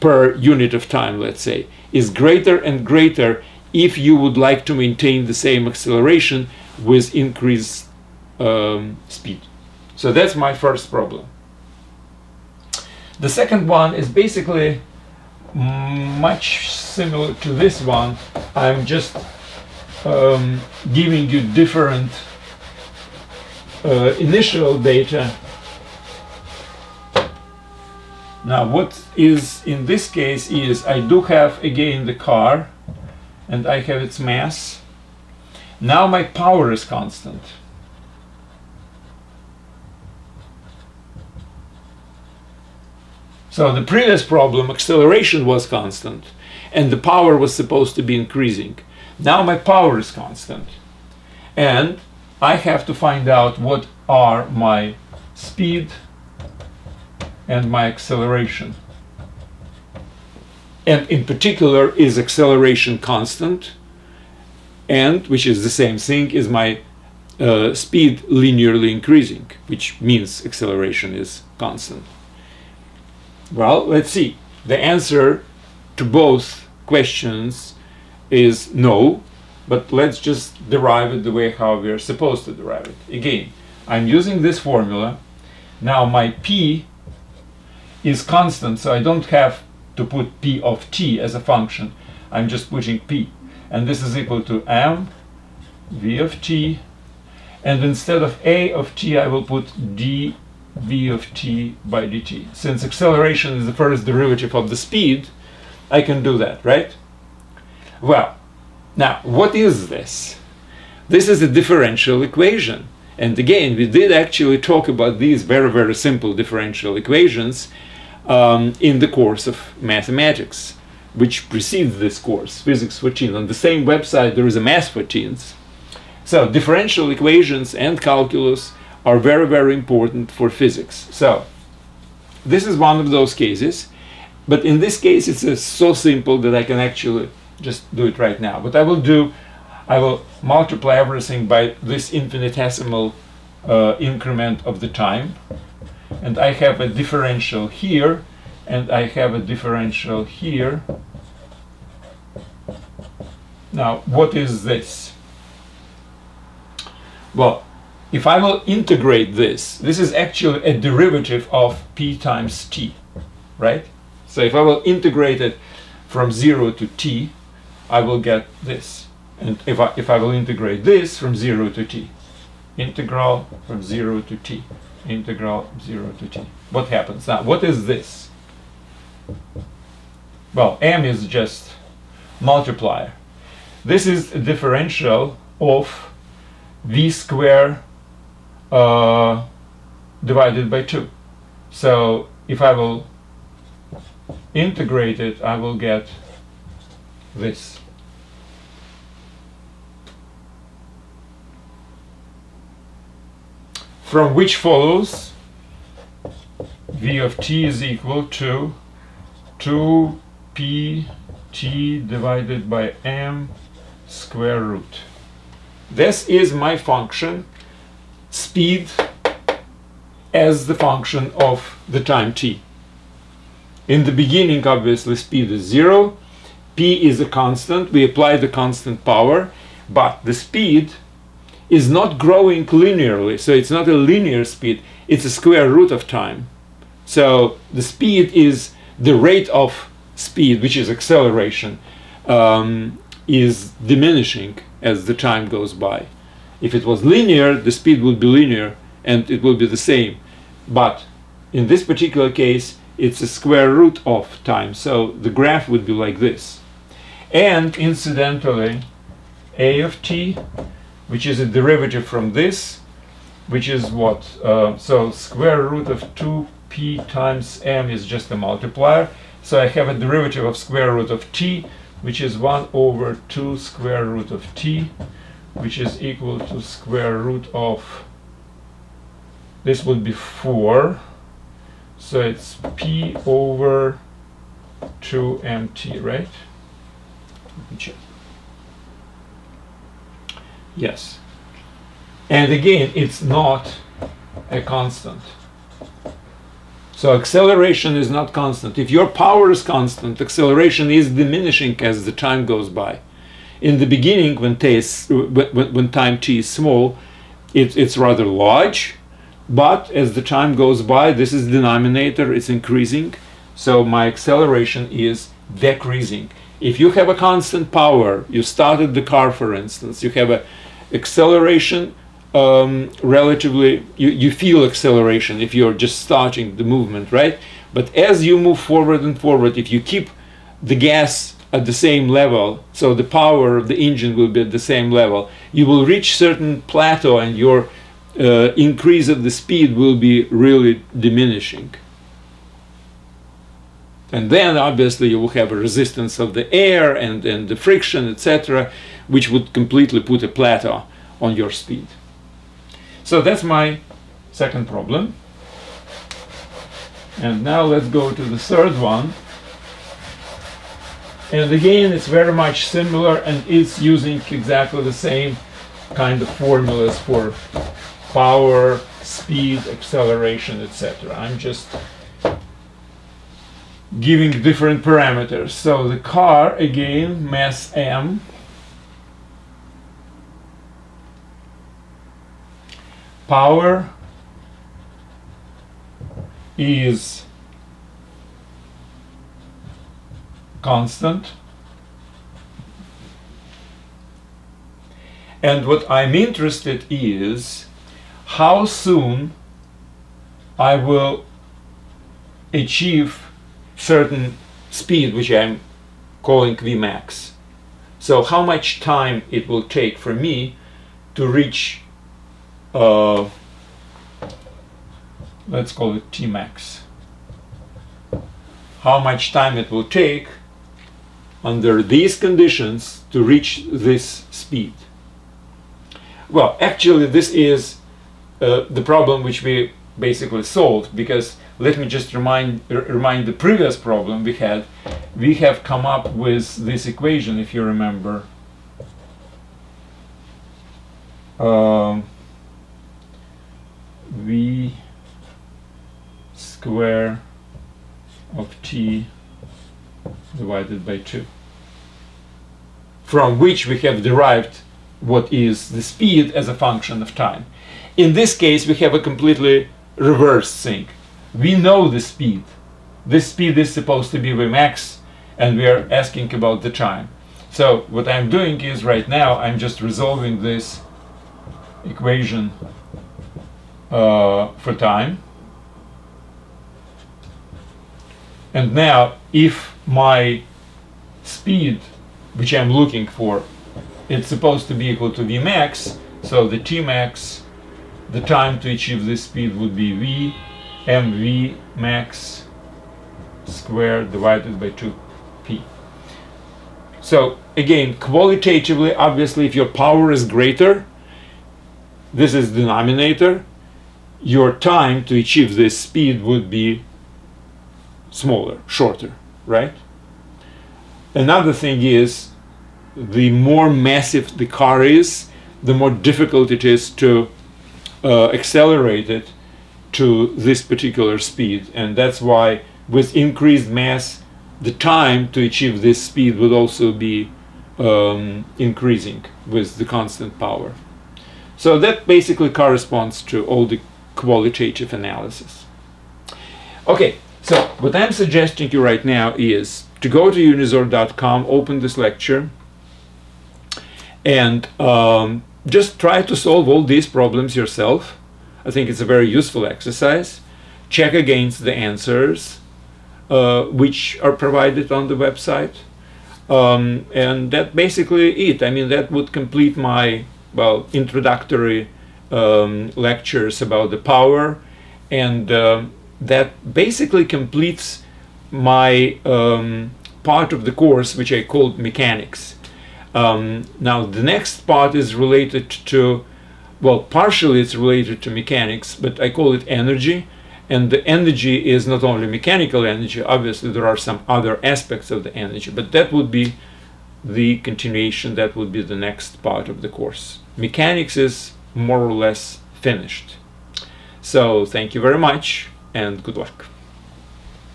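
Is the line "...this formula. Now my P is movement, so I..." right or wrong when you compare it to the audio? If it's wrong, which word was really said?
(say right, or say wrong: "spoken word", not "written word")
wrong: "constant", not "movement".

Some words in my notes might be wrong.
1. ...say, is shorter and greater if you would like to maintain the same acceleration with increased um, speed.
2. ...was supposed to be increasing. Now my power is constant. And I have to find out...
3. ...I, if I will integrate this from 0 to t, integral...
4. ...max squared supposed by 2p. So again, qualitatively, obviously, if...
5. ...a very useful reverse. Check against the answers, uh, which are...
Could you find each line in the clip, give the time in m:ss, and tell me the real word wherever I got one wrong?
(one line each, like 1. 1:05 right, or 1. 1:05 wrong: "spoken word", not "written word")
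1. 0:01 wrong: "greater", not "shorter"
2. 0:47 right
3. 2:49 right
4. 8:11 wrong: "divided", not "supposed"
5. 9:08 wrong: "exercise", not "reverse".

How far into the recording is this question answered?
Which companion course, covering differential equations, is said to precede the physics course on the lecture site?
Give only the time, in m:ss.
2:04.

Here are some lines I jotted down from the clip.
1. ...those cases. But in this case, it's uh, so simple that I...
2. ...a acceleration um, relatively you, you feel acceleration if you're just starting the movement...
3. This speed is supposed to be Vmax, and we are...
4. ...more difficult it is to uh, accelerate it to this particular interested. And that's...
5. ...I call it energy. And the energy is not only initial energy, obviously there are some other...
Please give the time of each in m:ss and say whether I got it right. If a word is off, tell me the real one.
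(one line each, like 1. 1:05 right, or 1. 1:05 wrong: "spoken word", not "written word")
1. 2:13 right
2. 5:20 right
3. 7:43 right
4. 8:35 wrong: "speed", not "interested"
5. 9:39 wrong: "mechanical", not "initial".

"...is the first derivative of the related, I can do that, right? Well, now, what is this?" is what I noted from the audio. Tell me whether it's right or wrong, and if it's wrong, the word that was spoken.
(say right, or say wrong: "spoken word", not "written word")
wrong: "speed", not "related".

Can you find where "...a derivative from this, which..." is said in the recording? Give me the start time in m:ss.
4:21.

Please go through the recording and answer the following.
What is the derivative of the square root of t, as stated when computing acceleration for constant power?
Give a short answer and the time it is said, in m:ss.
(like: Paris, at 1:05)
1 over 2 square root of t, at 4:32.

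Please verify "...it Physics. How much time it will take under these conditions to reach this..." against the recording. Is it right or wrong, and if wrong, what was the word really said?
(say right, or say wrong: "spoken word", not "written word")
wrong: "Tmax", not "Physics".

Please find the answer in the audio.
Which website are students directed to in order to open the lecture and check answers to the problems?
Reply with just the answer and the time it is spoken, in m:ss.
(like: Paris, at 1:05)
unizor.com, at 9:00.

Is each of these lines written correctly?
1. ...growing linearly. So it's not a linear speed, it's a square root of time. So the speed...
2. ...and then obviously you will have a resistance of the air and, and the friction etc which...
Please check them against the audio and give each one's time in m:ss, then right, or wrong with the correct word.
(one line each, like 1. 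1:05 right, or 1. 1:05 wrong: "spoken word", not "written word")
1. 3:52 right
2. 5:44 right.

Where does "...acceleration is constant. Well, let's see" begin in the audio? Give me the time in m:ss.
1:10.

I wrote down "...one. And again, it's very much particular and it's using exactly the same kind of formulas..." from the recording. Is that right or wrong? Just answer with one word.
wrong.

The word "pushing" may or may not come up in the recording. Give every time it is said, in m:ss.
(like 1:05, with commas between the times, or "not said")
1:32.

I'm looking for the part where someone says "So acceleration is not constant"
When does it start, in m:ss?
4:56.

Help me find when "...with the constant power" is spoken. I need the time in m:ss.
8:49.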